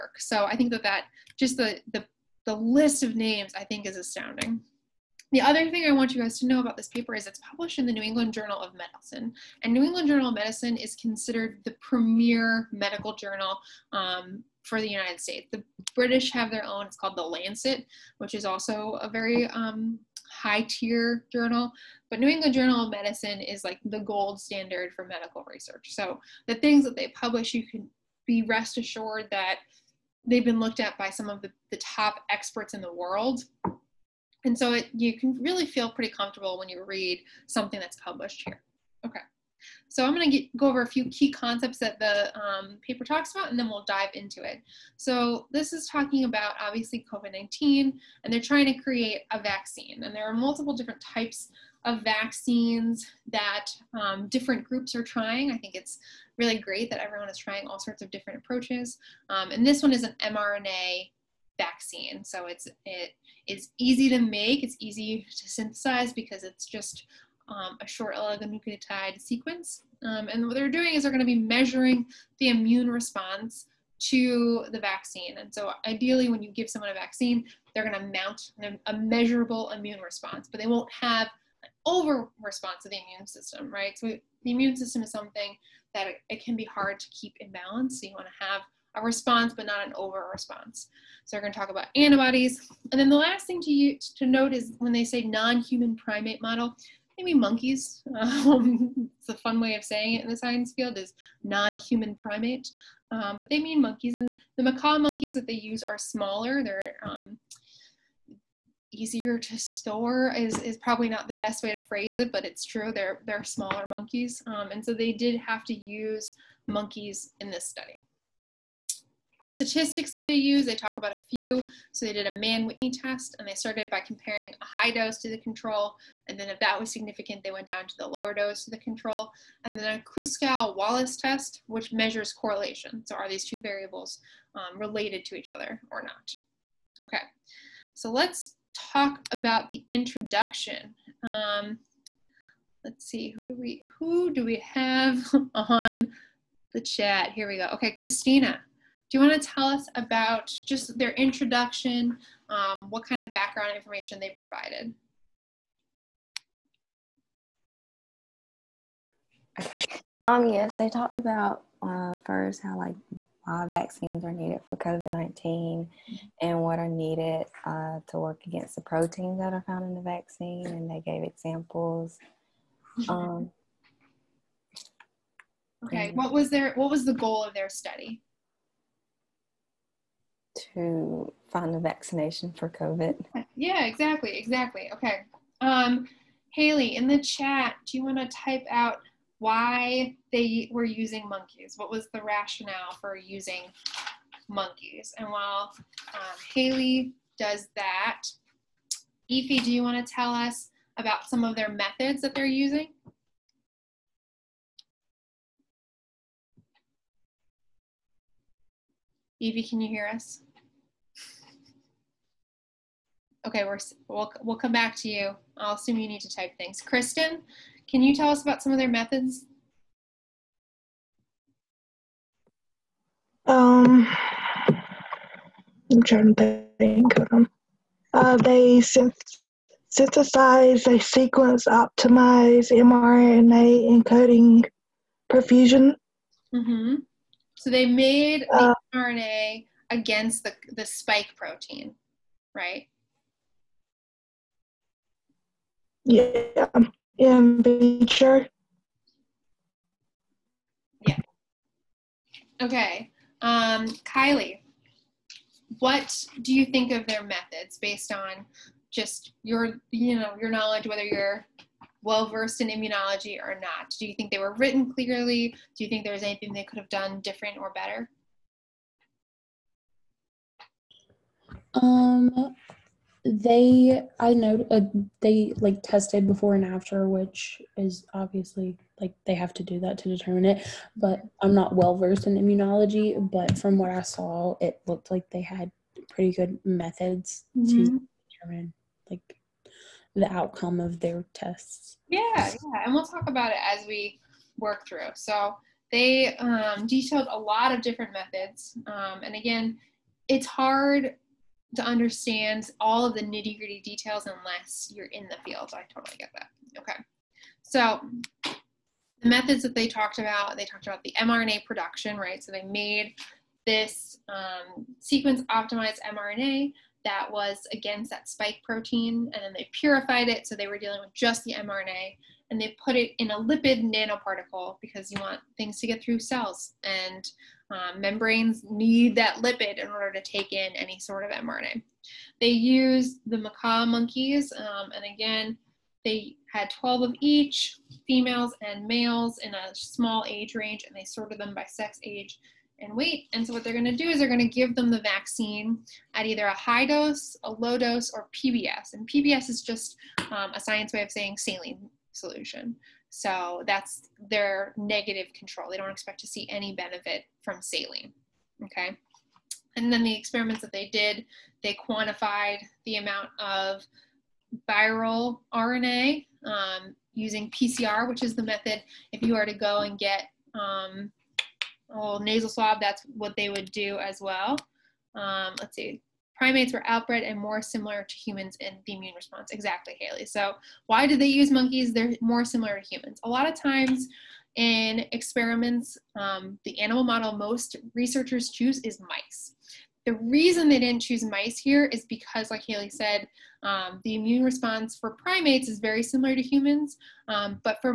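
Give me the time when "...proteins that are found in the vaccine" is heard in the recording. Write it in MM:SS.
02:48.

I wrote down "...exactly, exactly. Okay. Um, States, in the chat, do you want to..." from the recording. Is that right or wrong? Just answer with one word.
wrong.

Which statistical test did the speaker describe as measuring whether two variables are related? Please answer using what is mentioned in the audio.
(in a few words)
Kruskal Wallis test.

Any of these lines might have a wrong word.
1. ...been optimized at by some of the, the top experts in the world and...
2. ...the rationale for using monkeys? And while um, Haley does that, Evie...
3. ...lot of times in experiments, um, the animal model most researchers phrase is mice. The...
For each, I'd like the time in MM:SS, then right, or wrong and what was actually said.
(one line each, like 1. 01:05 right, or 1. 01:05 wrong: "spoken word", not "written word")
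1. 00:30 wrong: "looked", not "optimized"
2. 03:12 right
3. 06:23 wrong: "choose", not "phrase".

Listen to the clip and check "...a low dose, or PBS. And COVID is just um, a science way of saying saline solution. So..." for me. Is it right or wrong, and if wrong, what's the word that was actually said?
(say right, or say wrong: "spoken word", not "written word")
wrong: "PBS", not "COVID".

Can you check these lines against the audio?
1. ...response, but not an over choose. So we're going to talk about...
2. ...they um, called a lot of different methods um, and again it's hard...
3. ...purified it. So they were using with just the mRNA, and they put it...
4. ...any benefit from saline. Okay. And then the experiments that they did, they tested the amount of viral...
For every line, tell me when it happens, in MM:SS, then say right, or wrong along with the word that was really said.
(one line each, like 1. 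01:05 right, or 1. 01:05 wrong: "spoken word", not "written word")
1. 01:29 wrong: "response", not "choose"
2. 04:55 wrong: "detailed", not "called"
3. 05:19 wrong: "dealing", not "using"
4. 05:56 wrong: "quantified", not "tested".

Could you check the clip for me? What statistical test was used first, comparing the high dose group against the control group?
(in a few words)
Mann Whitney test.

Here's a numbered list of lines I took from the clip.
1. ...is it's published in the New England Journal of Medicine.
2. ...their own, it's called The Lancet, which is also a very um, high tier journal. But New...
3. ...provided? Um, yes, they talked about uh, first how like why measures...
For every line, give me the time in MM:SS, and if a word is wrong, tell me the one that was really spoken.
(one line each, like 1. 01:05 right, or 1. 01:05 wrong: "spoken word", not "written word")
1. 00:07 right
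2. 00:16 right
3. 02:34 wrong: "vaccines", not "measures".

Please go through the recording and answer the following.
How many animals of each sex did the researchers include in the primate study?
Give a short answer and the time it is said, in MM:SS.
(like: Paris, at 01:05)
12, at 05:36.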